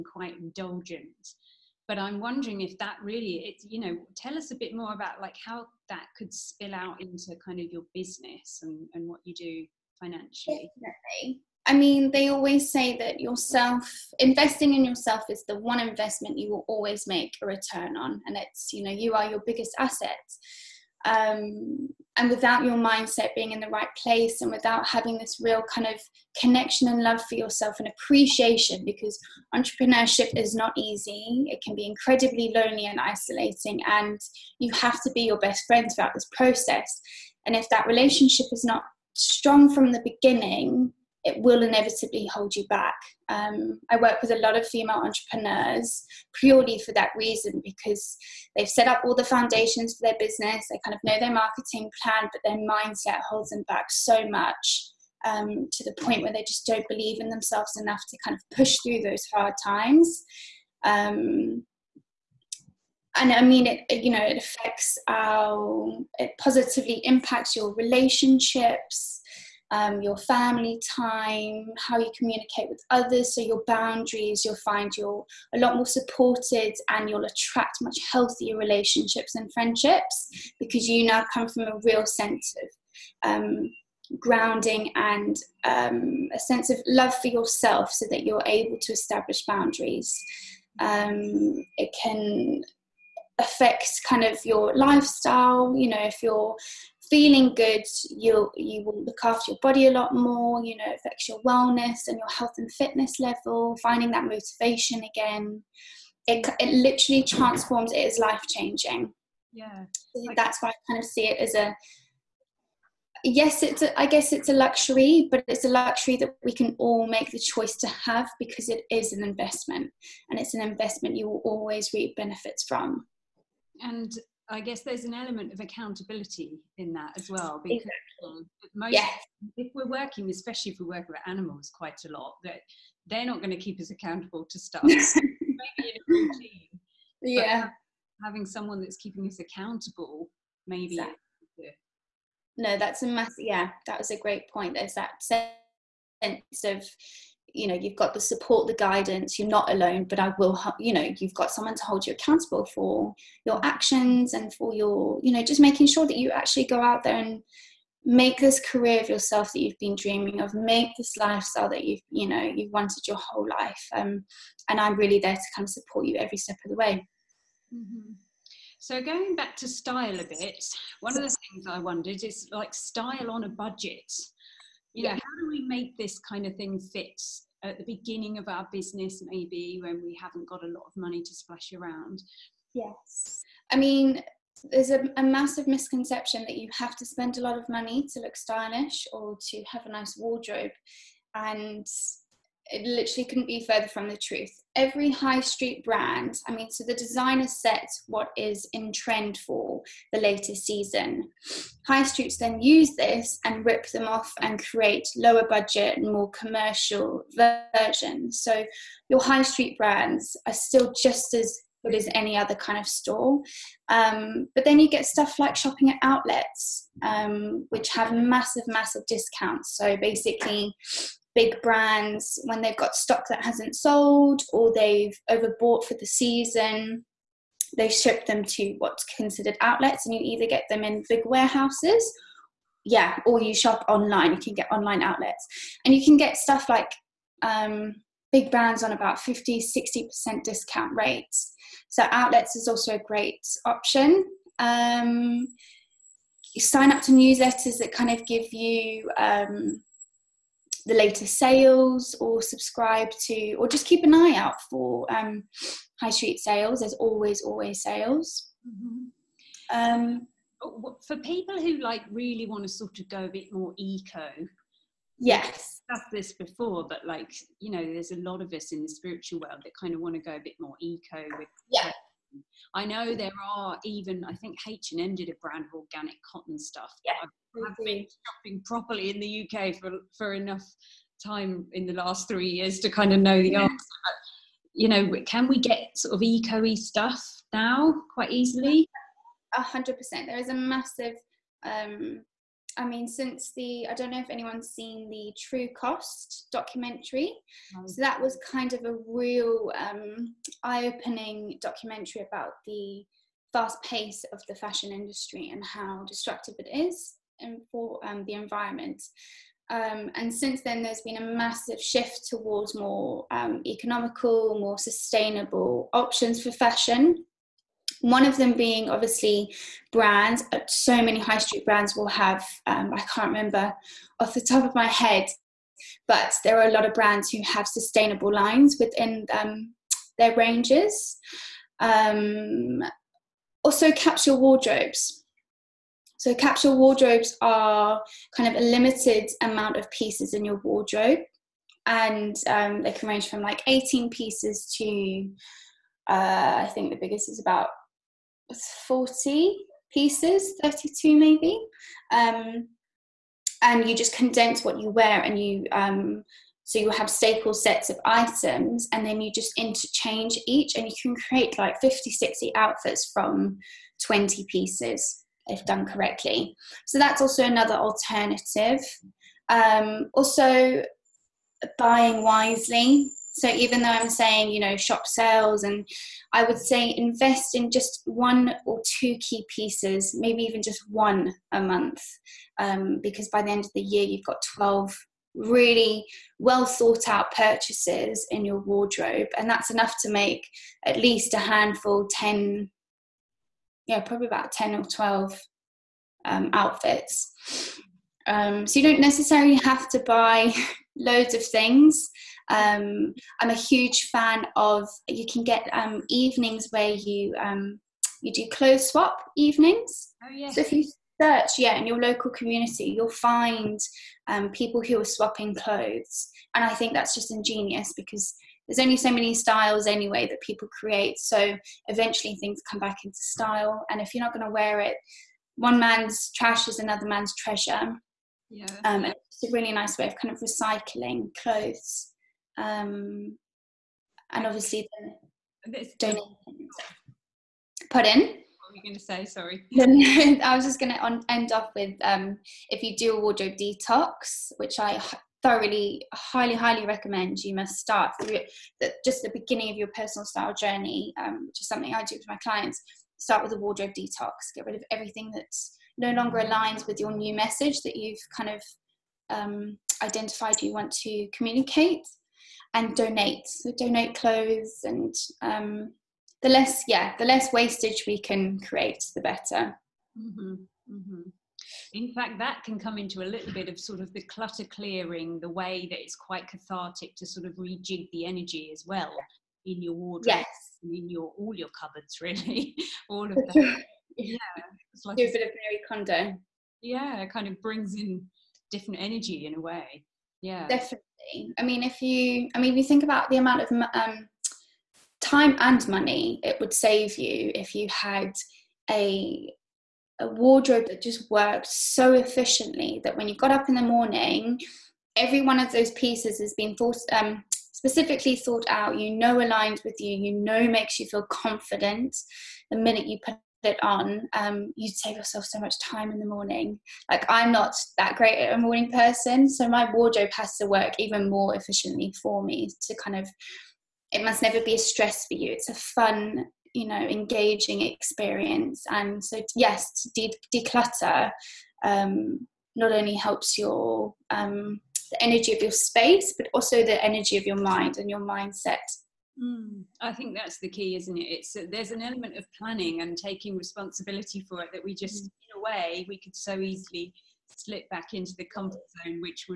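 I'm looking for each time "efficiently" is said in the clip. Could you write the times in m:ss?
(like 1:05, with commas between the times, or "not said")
8:22, 8:41.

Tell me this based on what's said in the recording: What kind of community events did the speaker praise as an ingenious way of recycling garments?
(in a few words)
Clothes swap evenings.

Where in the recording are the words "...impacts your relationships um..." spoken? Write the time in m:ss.
1:07.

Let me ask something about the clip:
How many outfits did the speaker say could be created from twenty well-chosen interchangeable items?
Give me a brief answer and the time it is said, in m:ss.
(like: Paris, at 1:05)
50-60, at 6:01.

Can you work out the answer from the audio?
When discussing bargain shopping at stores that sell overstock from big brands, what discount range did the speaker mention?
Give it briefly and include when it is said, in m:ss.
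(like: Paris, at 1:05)
50-60%, at 3:59.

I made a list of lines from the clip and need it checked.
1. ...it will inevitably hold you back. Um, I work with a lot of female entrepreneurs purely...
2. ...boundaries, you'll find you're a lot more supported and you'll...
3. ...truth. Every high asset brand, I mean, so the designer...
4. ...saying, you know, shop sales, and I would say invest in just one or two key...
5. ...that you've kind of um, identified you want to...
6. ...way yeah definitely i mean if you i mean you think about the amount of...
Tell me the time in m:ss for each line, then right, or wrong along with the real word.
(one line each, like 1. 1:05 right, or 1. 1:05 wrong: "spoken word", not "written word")
1. 0:41 right
2. 1:13 right
3. 3:14 wrong: "street", not "asset"
4. 6:14 right
5. 7:37 right
6. 8:09 right.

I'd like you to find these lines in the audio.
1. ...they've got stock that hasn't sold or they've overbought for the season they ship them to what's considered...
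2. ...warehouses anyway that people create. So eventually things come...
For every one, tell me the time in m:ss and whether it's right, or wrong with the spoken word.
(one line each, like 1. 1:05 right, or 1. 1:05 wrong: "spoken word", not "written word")
1. 3:42 right
2. 6:59 wrong: "styles", not "warehouses".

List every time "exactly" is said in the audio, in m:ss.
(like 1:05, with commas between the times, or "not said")
2:07, 2:20.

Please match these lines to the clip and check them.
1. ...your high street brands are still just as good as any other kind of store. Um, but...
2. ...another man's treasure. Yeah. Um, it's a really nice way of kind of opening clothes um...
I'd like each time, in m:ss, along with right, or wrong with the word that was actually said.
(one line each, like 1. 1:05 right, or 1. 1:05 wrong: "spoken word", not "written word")
1. 3:29 right
2. 7:06 wrong: "recycling", not "opening".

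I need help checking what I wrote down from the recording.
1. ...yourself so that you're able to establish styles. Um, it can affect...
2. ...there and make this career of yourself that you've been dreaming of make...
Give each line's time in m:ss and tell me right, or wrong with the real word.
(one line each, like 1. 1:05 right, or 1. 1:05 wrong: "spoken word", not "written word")
1. 1:27 wrong: "boundaries", not "styles"
2. 2:37 right.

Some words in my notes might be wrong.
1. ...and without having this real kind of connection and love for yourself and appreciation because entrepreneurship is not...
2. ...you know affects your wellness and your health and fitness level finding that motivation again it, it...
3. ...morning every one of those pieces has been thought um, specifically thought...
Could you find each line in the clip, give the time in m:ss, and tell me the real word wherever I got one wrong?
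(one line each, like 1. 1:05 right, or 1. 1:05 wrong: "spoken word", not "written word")
1. 0:24 right
2. 1:40 right
3. 8:23 right.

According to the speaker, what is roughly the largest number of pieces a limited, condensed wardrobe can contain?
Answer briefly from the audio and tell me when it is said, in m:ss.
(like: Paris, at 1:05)
40, at 5:48.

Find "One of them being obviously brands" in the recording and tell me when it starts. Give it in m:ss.
5:18.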